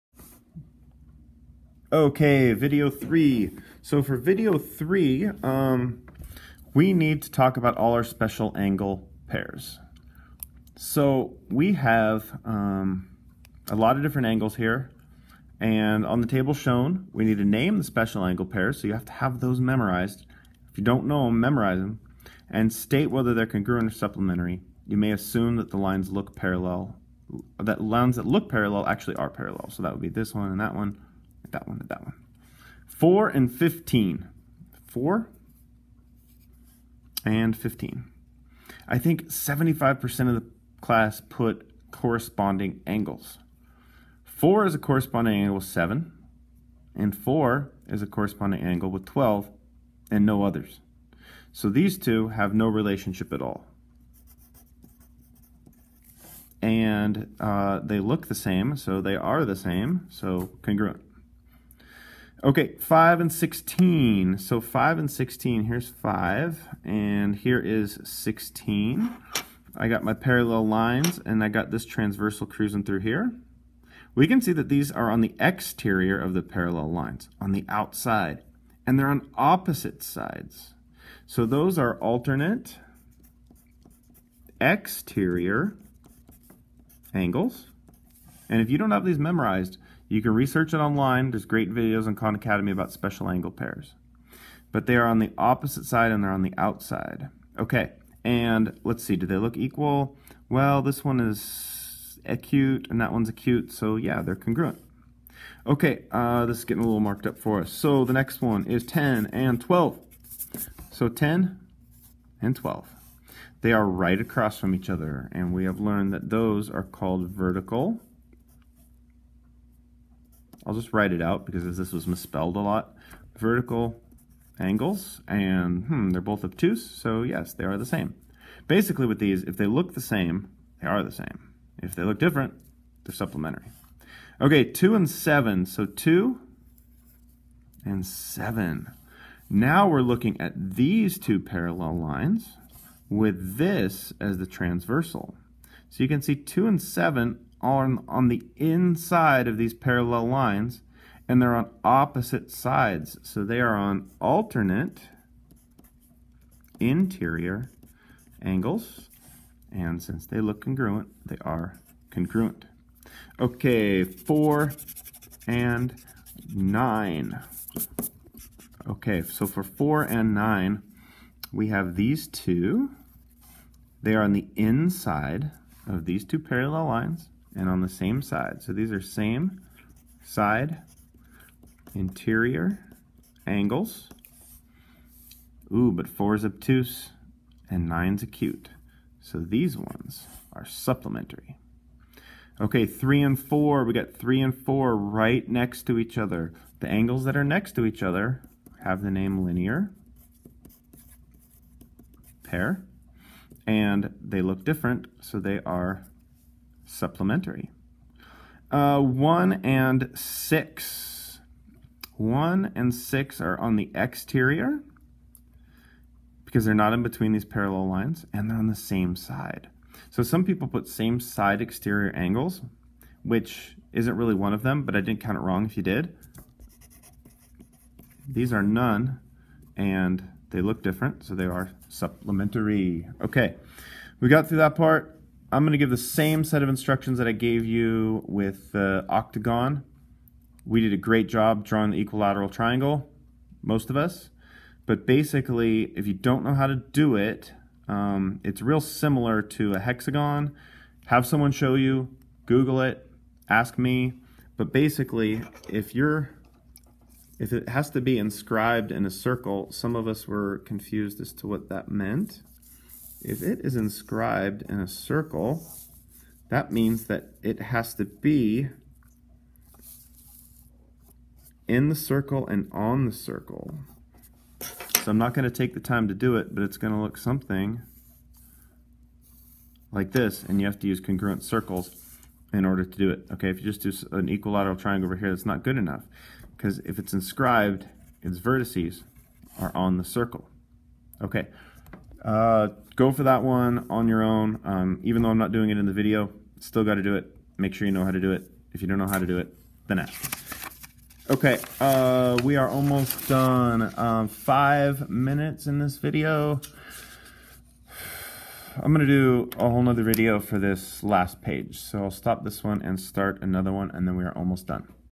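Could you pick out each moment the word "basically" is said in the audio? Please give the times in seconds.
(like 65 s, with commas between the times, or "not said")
128 s, 245 s, 254 s.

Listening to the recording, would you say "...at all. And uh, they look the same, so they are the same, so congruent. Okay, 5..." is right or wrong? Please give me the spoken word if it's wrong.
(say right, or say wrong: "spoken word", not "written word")
right.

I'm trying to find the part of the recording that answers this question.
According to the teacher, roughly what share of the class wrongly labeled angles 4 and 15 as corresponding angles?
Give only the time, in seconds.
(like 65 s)
39 s.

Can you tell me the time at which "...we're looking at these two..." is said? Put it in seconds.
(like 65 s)
139 s.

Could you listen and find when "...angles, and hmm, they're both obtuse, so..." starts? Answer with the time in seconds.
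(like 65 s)
124 s.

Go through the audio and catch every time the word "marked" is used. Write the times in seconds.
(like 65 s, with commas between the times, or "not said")
106 s.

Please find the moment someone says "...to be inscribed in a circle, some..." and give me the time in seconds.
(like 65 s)
257 s.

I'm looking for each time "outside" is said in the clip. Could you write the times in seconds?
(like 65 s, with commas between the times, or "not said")
77 s, 96 s.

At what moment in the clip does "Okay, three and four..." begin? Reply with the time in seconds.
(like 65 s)
192 s.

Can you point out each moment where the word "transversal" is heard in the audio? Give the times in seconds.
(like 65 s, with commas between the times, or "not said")
71 s, 144 s.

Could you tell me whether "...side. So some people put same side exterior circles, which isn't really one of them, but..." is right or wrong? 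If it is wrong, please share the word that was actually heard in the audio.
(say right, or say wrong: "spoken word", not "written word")
wrong: "angles", not "circles".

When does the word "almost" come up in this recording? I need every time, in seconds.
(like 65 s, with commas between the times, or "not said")
302 s, 314 s.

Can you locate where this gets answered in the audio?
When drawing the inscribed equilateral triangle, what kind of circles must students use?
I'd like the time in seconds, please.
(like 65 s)
280 s.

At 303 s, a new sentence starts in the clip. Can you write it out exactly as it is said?
Um, five minutes in this video.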